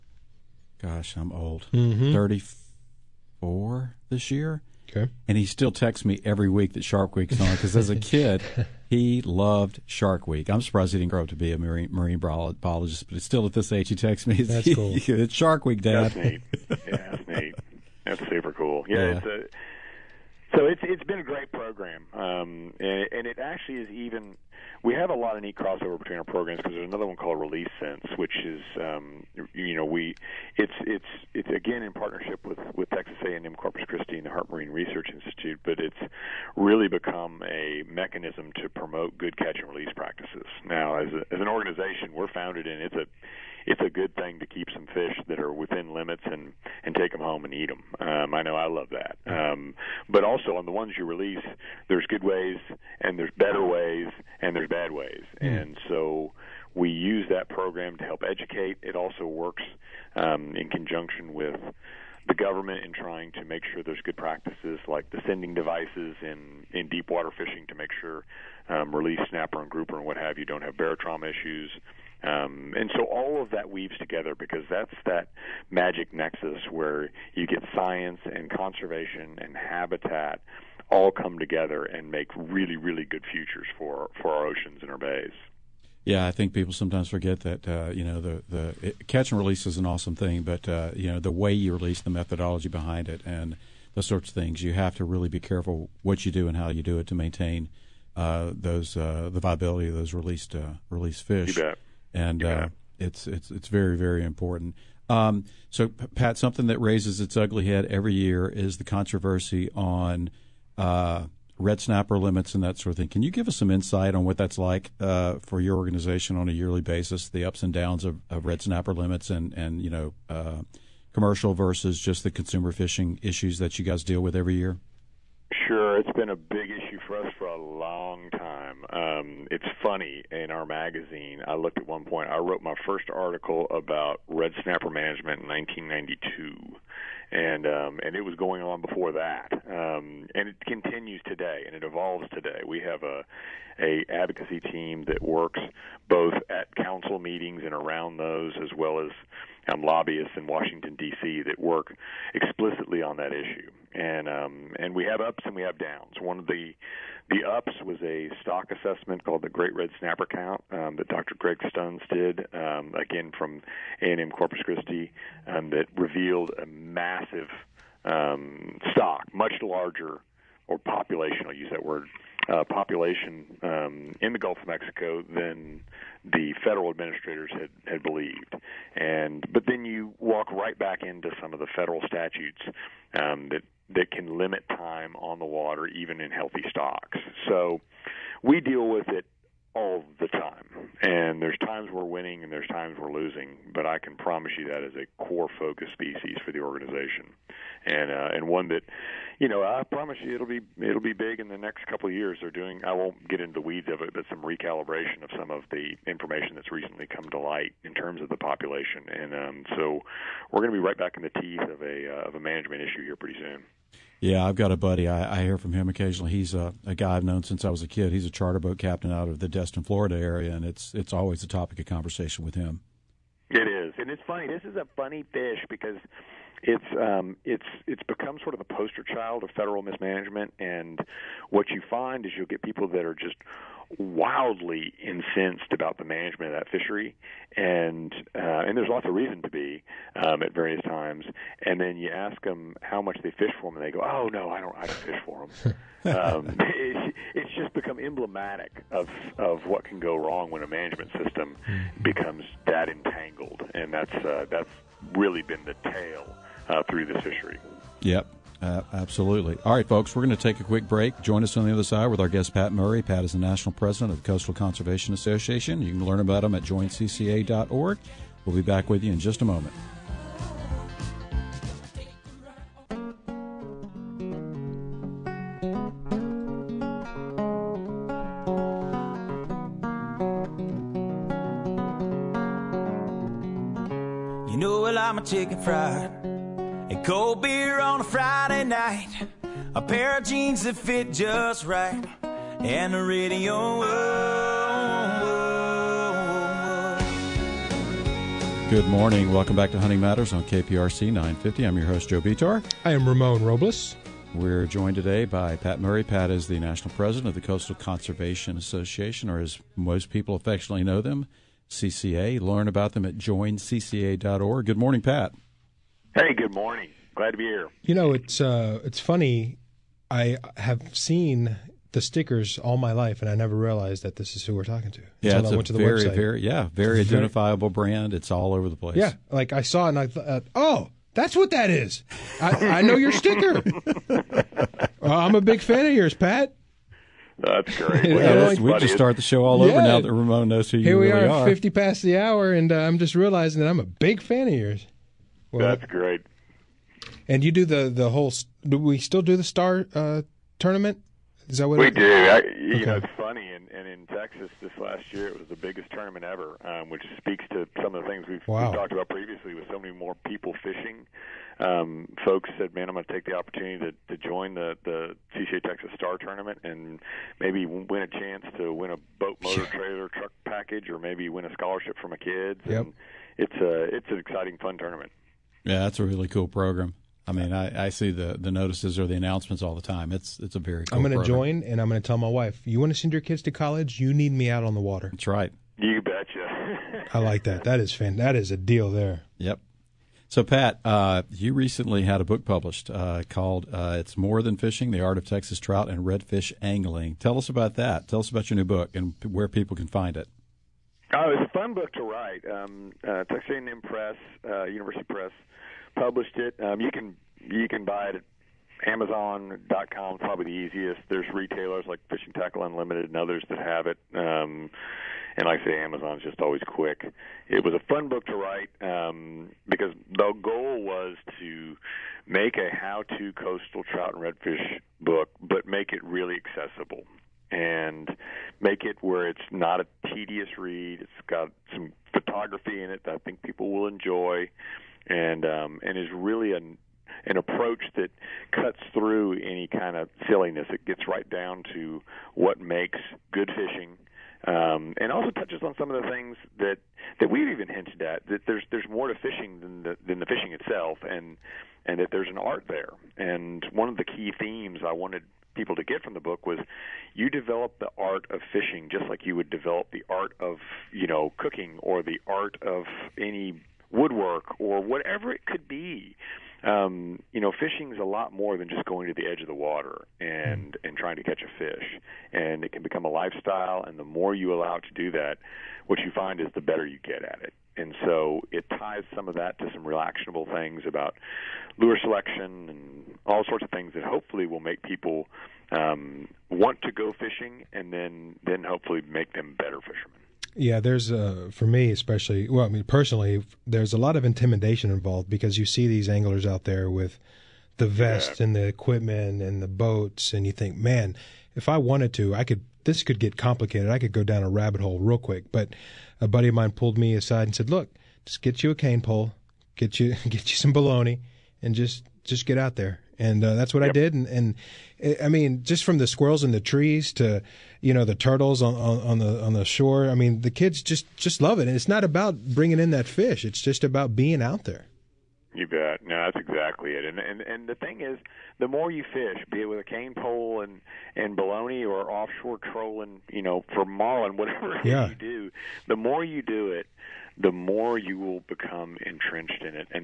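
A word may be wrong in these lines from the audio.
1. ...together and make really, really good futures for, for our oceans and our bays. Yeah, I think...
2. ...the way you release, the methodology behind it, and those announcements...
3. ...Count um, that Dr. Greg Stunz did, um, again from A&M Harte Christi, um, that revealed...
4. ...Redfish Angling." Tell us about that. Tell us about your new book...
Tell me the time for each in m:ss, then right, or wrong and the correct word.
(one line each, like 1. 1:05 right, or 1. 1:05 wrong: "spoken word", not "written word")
1. 1:21 right
2. 1:31 wrong: "sorts", not "announcements"
3. 2:40 wrong: "Corpus", not "Harte"
4. 6:36 right.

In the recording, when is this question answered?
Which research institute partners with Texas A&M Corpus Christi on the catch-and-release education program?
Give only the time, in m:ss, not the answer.
0:34.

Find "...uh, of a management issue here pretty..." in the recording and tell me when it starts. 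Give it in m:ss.
3:32.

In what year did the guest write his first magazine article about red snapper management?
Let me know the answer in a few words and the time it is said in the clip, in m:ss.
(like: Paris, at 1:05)
1992, at 2:15.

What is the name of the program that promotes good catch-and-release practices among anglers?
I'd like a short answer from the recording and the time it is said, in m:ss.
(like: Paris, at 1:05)
Release Sense, at 0:27.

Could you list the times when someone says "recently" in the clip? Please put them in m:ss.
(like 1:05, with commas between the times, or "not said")
3:26, 6:31.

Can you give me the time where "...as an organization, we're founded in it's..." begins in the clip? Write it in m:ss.
0:41.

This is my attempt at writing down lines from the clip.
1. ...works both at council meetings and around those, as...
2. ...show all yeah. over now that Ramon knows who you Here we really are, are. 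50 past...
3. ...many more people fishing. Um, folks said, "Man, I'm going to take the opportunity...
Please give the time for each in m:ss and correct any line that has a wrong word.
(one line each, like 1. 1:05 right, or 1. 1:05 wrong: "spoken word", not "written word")
1. 2:25 right
2. 5:39 right
3. 5:59 right.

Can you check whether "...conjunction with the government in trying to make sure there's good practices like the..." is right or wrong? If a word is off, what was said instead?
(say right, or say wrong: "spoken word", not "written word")
right.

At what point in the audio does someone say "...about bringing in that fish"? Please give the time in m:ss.
8:42.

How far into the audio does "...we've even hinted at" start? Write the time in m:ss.
7:27.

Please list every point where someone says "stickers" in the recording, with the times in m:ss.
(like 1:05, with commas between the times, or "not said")
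5:21, 5:33.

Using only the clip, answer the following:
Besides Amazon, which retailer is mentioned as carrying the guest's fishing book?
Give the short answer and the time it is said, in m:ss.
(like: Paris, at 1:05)
Fishing Tackle Unlimited, at 6:52.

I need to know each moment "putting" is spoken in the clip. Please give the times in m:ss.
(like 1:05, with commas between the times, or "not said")
not said.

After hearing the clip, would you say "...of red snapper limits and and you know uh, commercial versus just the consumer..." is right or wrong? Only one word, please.
right.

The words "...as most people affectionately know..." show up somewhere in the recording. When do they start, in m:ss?
5:09.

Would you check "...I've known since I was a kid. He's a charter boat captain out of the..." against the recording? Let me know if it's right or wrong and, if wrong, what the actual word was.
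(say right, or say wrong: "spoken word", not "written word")
right.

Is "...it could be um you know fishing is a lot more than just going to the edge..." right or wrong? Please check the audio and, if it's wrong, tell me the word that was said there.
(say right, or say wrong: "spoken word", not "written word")
right.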